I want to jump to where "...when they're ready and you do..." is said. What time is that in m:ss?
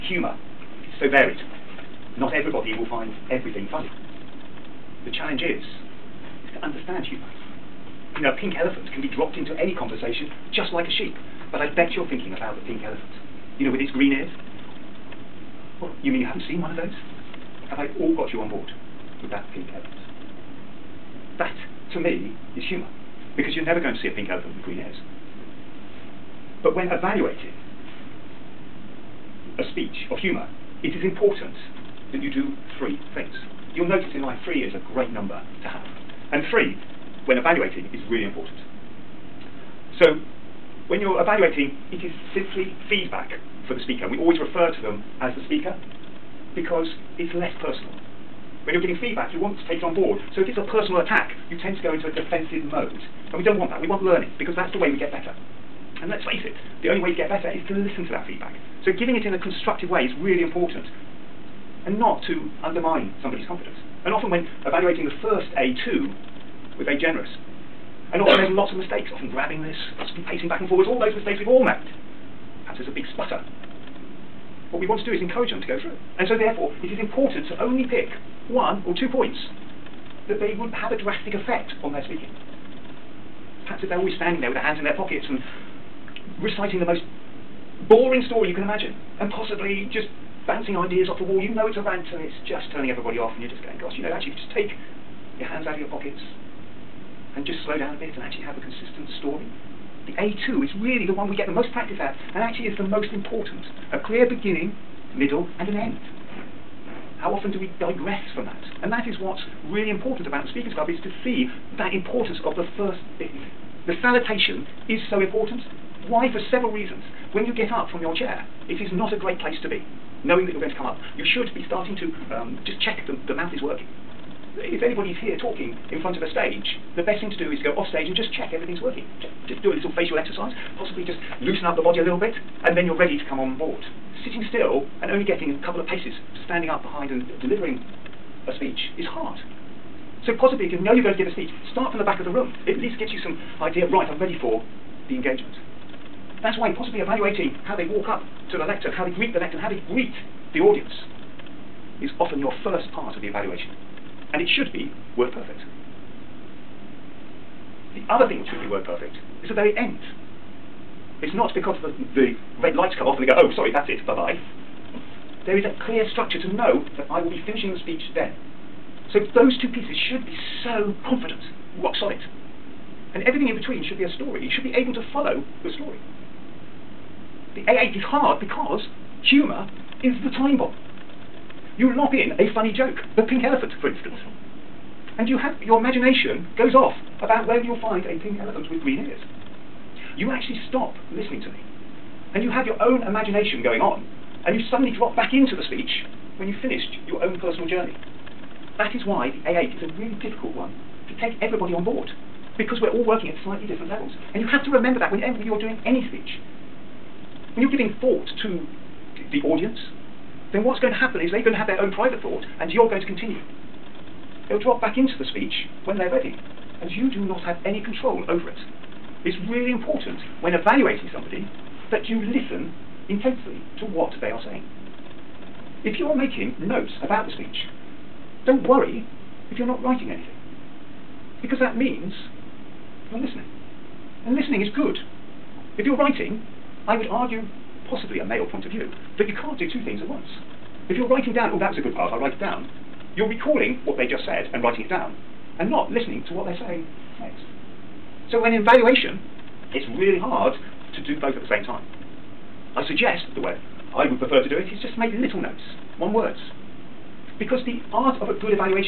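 3:35.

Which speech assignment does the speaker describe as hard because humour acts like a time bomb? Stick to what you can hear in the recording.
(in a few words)
A8.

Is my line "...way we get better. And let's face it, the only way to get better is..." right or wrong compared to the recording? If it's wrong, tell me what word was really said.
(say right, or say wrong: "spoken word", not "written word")
right.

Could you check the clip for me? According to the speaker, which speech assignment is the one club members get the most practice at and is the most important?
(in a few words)
A2.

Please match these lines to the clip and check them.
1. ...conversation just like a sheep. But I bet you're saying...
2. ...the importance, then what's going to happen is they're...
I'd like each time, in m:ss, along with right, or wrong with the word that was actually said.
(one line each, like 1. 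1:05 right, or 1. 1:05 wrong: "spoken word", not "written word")
1. 0:09 wrong: "thinking", not "saying"
2. 3:29 wrong: "audience", not "importance".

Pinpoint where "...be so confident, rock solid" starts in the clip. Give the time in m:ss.
2:50.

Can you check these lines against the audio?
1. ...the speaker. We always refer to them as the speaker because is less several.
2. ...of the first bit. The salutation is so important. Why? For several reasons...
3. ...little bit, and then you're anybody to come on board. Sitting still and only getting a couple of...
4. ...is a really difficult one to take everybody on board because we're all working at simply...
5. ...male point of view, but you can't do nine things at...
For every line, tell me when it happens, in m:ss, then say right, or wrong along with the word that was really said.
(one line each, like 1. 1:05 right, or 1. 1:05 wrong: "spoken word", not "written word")
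1. 0:43 wrong: "personal", not "several"
2. 1:52 right
3. 2:12 wrong: "ready", not "anybody"
4. 3:19 wrong: "slightly", not "simply"
5. 3:58 wrong: "two", not "nine".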